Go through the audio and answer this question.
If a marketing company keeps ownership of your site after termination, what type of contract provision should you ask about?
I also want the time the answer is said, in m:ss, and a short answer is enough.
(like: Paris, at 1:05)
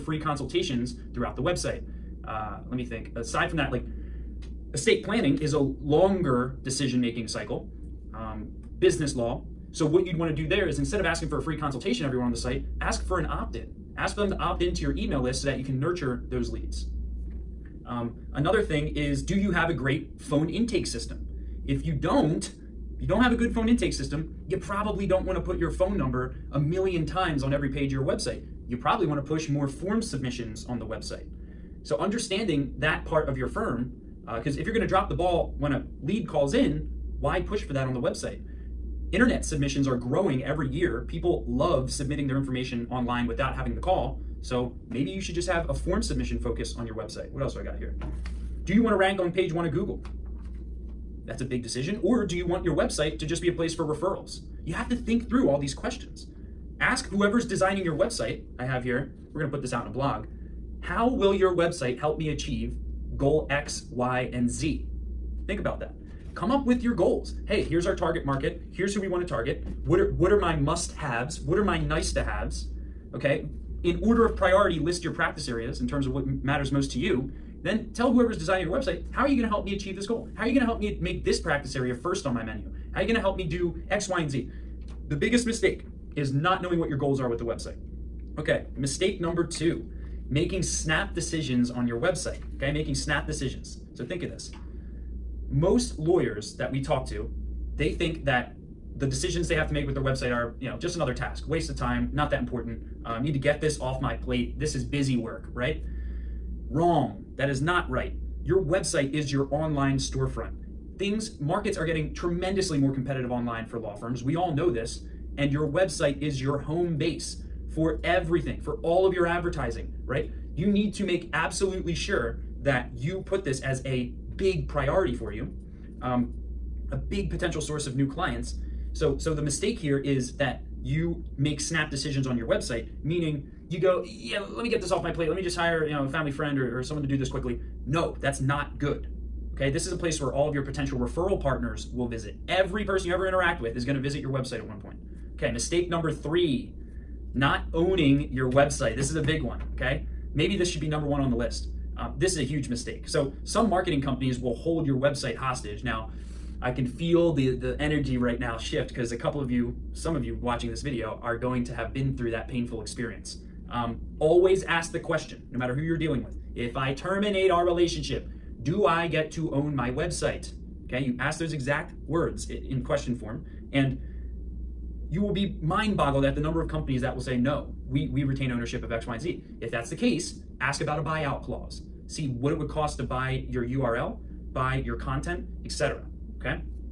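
Buyout clause, at 3:00.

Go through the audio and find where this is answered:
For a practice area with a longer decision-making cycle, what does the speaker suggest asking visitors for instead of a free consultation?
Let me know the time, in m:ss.
0:13.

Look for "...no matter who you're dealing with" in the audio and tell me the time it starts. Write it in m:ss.
2:45.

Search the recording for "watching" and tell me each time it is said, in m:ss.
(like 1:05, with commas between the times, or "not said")
2:40.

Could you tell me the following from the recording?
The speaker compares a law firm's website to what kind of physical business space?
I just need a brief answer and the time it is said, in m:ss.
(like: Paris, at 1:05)
Online storefront, at 1:49.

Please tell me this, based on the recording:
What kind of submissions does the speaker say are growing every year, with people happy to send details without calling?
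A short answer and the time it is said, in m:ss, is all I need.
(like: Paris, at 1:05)
Internet submissions, at 0:39.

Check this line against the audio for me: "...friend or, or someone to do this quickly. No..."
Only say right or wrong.
right.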